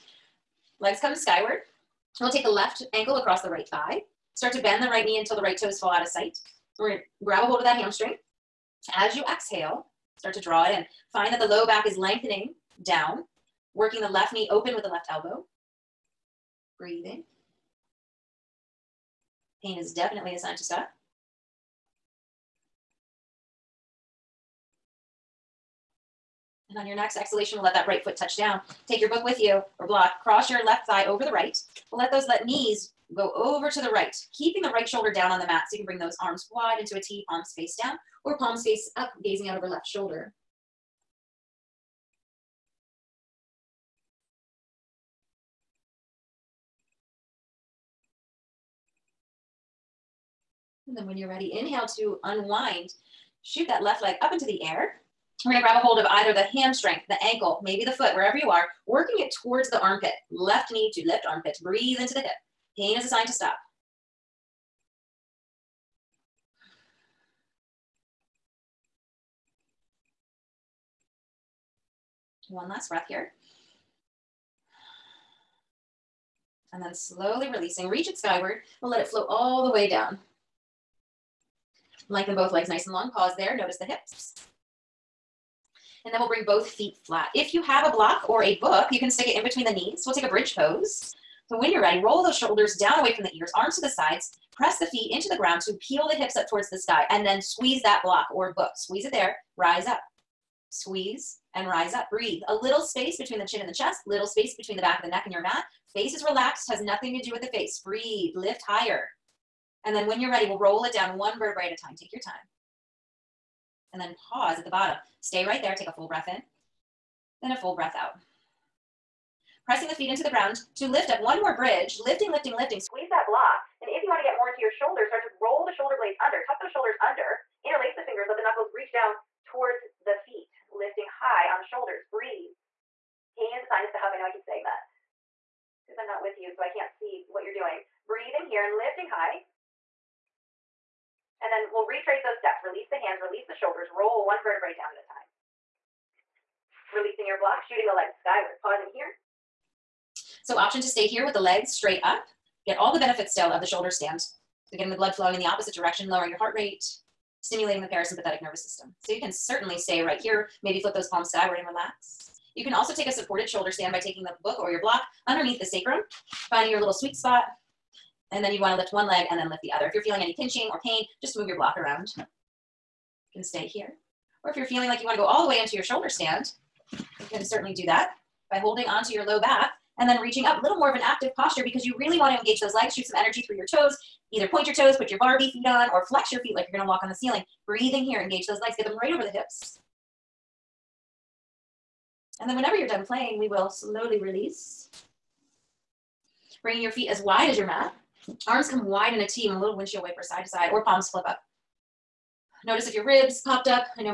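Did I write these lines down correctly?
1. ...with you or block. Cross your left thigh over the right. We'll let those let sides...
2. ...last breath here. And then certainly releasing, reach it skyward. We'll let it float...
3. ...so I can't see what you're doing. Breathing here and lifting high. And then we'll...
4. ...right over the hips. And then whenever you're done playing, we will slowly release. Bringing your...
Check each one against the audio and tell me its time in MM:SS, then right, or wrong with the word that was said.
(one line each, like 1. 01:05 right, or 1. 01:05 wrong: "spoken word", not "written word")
1. 00:29 wrong: "knees", not "sides"
2. 01:12 wrong: "slowly", not "certainly"
3. 02:16 right
4. 03:09 right.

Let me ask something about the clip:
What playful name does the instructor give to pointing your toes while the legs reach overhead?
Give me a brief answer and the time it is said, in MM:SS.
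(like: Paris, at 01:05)
Barbie feet, at 03:05.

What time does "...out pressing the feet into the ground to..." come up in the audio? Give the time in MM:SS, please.
01:57.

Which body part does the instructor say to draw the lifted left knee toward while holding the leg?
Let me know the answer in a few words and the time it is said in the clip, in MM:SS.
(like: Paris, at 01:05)
left armpit, at 01:01.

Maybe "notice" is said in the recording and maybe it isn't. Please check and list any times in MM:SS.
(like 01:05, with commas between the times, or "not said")
01:23, 03:22.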